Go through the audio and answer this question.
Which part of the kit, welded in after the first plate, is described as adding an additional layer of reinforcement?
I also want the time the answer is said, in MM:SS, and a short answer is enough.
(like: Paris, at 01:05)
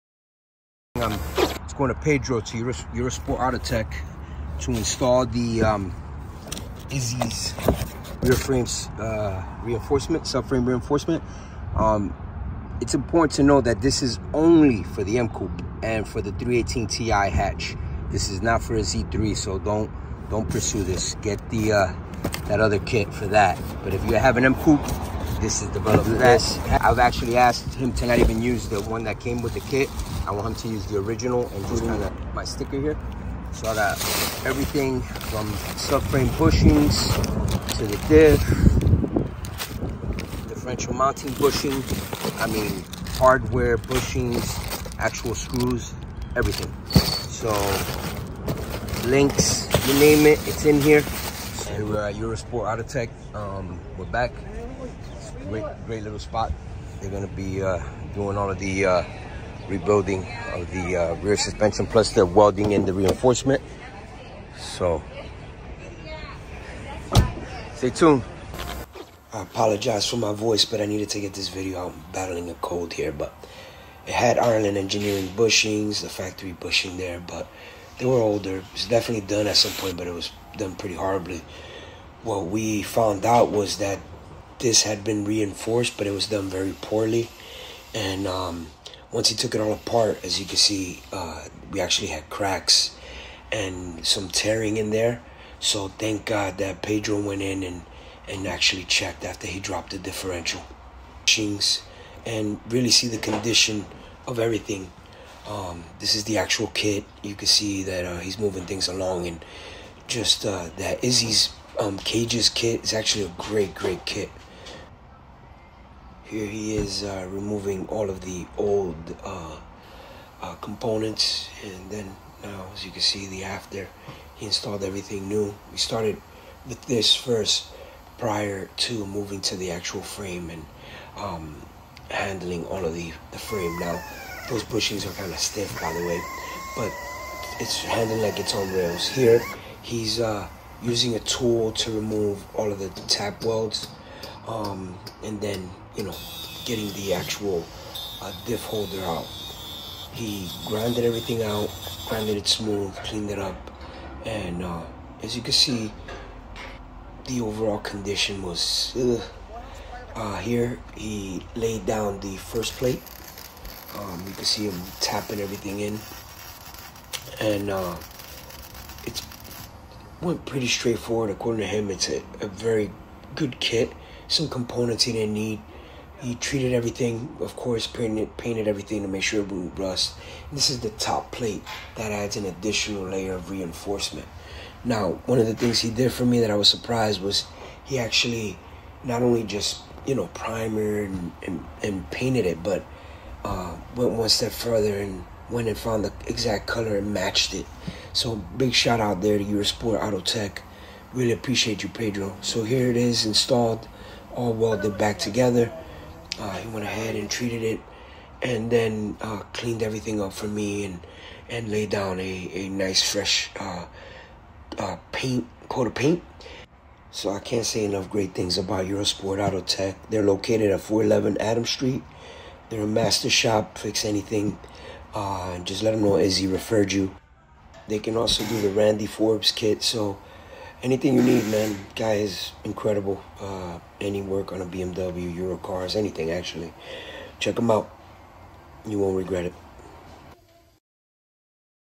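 top plate, at 03:00.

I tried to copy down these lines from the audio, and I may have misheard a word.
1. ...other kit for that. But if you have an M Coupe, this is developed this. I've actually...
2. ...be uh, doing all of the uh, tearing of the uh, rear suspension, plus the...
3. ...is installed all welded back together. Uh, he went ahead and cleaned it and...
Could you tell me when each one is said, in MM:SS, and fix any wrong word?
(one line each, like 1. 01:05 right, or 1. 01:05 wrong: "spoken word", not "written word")
1. 00:22 right
2. 00:57 wrong: "rebuilding", not "tearing"
3. 03:22 wrong: "treated", not "cleaned".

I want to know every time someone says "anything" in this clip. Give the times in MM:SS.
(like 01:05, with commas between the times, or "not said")
03:44, 03:50, 03:55.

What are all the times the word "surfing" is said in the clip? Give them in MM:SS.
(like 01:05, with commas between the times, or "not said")
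not said.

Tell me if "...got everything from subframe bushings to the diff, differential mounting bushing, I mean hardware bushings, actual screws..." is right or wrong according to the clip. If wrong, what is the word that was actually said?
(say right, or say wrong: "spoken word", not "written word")
right.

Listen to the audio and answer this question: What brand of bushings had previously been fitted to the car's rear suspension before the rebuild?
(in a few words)
Ireland Engineering.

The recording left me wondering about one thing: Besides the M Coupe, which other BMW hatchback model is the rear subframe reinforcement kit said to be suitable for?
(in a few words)
318 Ti.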